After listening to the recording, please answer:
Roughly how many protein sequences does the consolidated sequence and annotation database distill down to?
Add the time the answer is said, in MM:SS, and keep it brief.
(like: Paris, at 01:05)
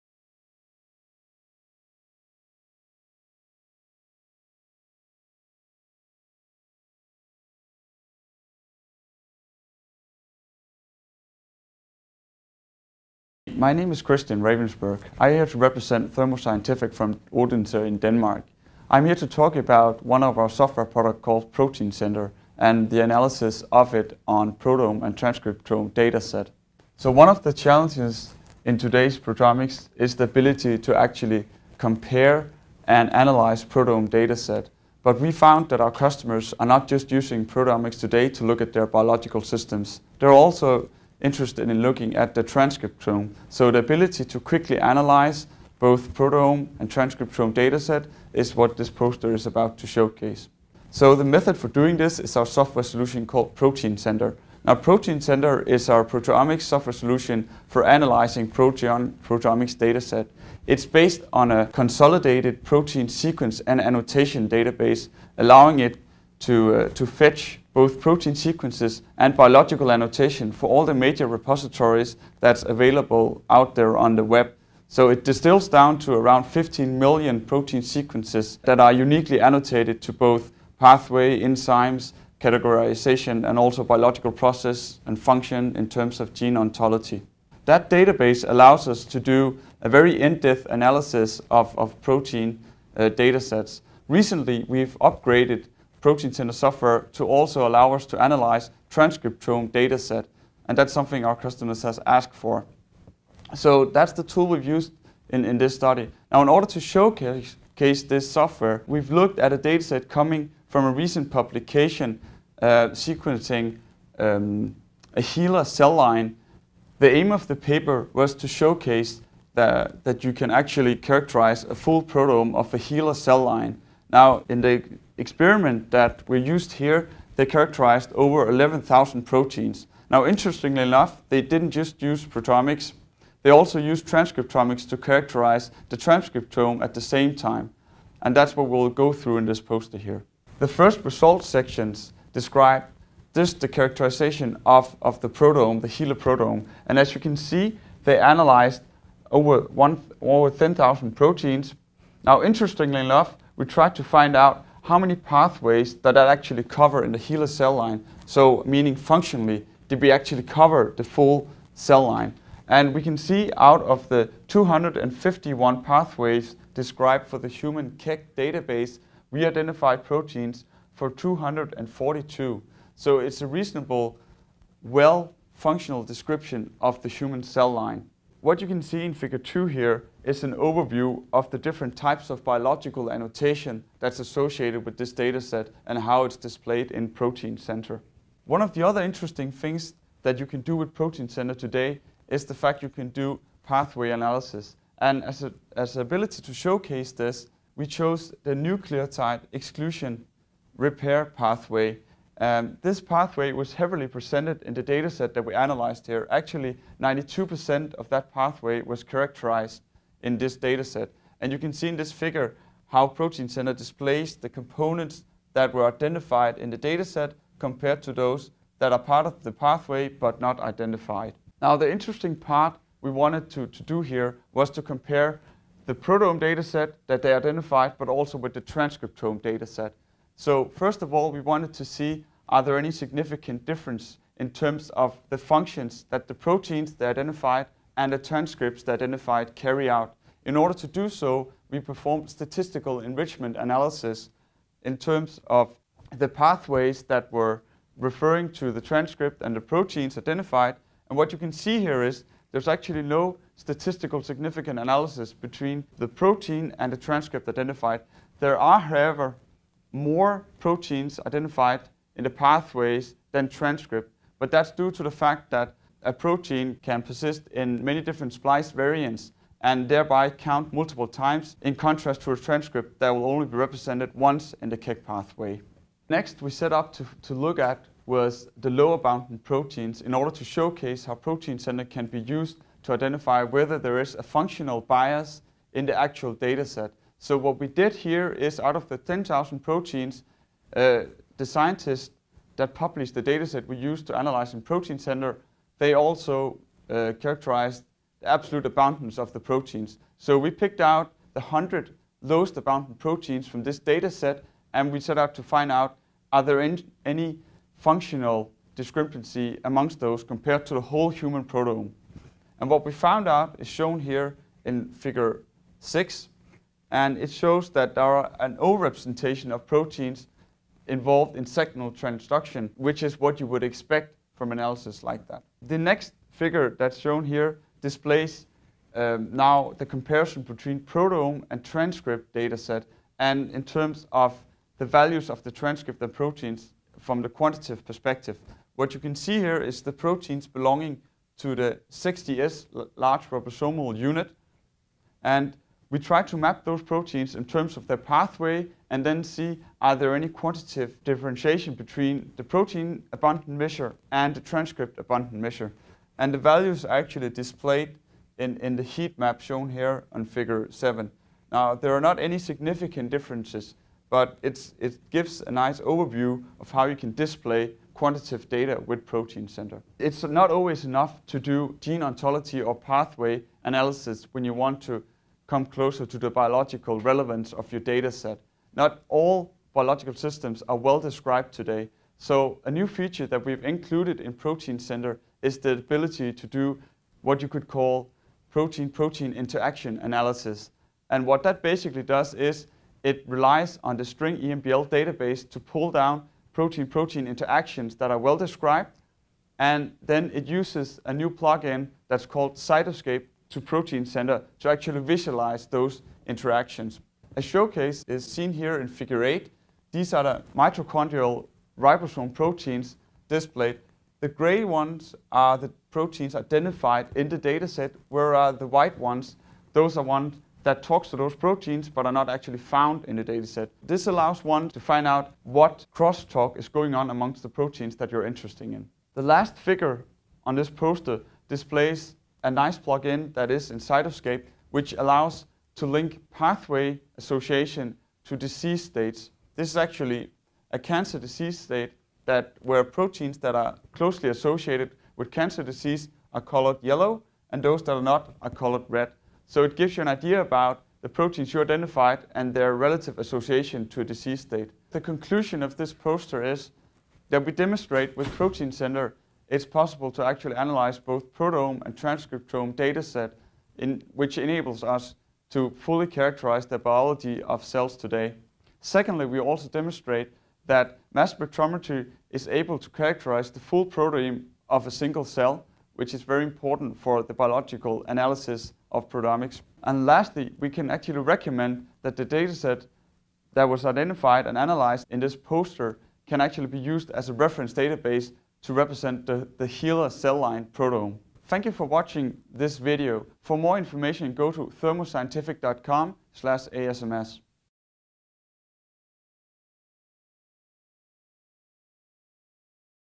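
15 million, at 01:16.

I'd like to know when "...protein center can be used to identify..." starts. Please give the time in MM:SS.
04:41.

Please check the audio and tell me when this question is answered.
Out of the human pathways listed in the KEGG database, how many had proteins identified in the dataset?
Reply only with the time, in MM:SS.
02:51.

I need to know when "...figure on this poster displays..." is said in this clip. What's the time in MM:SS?
07:09.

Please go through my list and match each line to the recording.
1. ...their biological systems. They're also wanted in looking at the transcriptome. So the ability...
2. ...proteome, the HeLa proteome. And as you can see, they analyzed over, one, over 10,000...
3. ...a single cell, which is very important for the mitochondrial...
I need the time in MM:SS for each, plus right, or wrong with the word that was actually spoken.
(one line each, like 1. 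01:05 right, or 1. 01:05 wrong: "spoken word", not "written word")
1. 00:38 wrong: "interested", not "wanted"
2. 02:25 right
3. 07:54 wrong: "biological", not "mitochondrial".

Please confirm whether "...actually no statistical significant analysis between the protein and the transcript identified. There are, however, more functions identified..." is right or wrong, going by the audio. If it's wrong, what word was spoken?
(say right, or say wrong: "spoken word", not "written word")
wrong: "proteins", not "functions".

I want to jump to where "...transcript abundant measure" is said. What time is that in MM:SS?
05:54.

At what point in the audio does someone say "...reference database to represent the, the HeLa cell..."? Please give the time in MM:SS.
08:07.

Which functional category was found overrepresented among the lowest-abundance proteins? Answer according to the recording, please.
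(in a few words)
signal transduction.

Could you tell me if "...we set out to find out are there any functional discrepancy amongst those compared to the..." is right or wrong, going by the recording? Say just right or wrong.
right.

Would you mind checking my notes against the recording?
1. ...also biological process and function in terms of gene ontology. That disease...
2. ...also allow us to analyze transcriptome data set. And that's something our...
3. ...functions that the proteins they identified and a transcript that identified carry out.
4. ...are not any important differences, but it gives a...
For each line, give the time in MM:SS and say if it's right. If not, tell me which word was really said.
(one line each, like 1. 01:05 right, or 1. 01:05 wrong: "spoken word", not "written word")
1. 01:23 wrong: "database", not "disease"
2. 01:37 right
3. 03:55 right
4. 06:01 wrong: "significant", not "important".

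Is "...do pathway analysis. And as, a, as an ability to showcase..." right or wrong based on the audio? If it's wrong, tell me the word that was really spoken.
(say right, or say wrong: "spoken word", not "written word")
right.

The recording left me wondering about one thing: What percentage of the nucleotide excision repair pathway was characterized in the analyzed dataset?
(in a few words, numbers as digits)
92%.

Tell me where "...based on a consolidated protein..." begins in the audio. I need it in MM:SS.
01:00.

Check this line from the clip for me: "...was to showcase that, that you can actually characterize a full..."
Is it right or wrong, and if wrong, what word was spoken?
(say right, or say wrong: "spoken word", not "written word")
right.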